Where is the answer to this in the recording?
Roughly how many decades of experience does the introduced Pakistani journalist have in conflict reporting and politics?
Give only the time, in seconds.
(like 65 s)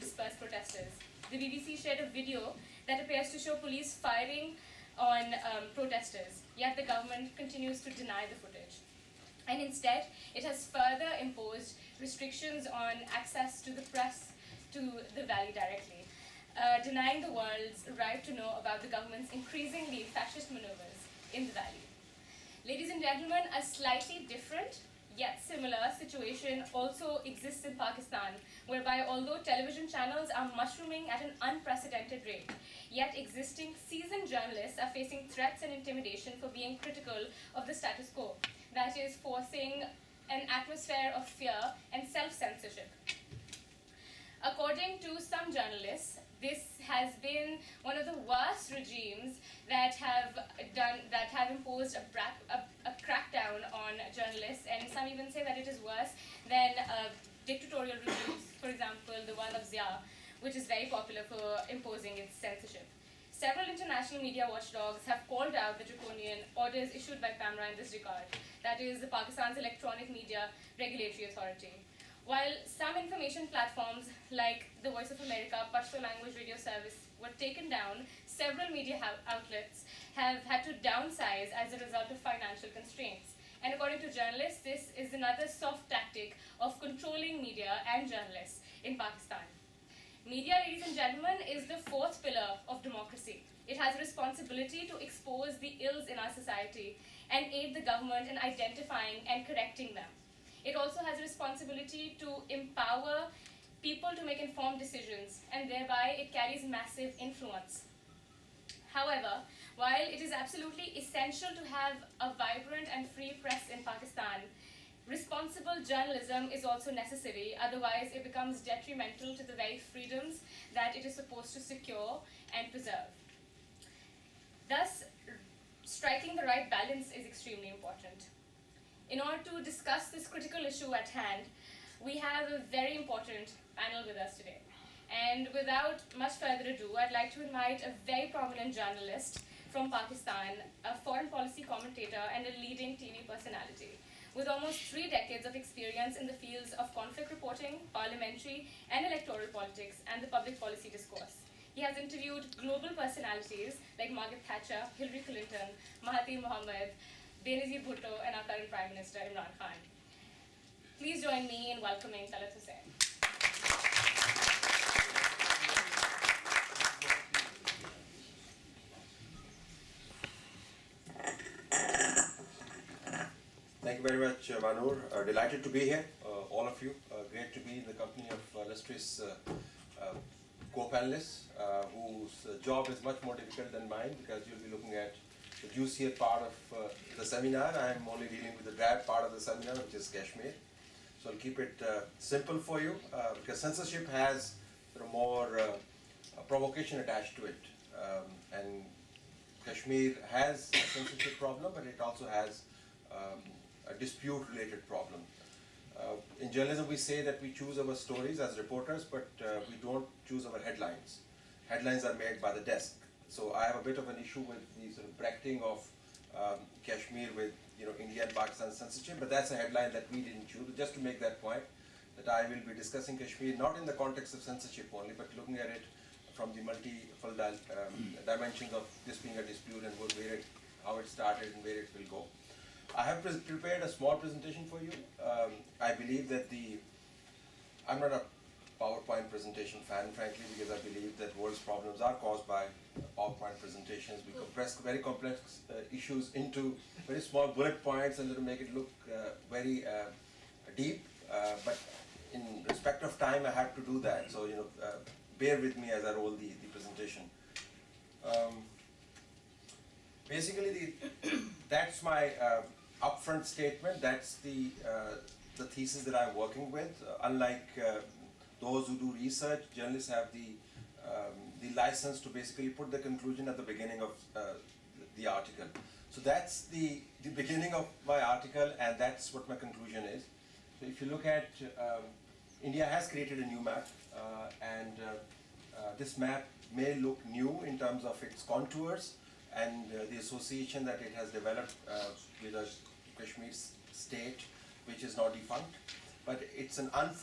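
144 s.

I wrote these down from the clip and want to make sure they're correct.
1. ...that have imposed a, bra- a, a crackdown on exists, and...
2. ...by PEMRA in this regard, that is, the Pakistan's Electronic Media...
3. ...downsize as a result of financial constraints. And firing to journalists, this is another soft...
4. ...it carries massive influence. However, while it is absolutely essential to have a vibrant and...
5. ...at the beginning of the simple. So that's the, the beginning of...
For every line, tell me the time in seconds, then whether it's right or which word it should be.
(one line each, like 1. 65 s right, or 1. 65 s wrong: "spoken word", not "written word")
1. 51 s wrong: "journalists", not "exists"
2. 67 s right
3. 80 s wrong: "according", not "firing"
4. 106 s right
5. 273 s wrong: "article", not "simple".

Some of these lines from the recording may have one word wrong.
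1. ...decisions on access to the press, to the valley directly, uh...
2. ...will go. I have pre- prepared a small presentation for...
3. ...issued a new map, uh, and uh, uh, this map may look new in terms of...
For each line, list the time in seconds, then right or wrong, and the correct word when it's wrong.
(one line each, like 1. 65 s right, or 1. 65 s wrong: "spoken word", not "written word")
1. 11 s wrong: "restrictions", not "decisions"
2. 231 s right
3. 283 s wrong: "created", not "issued".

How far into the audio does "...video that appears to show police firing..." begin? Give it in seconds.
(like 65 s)
2 s.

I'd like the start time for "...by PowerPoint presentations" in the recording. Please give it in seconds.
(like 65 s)
242 s.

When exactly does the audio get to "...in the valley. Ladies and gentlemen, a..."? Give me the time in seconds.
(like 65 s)
21 s.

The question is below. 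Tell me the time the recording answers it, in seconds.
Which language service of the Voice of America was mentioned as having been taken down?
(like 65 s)
75 s.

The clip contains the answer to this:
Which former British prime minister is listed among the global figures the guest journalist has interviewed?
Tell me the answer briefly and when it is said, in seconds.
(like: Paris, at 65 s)
Margaret Thatcher, at 154 s.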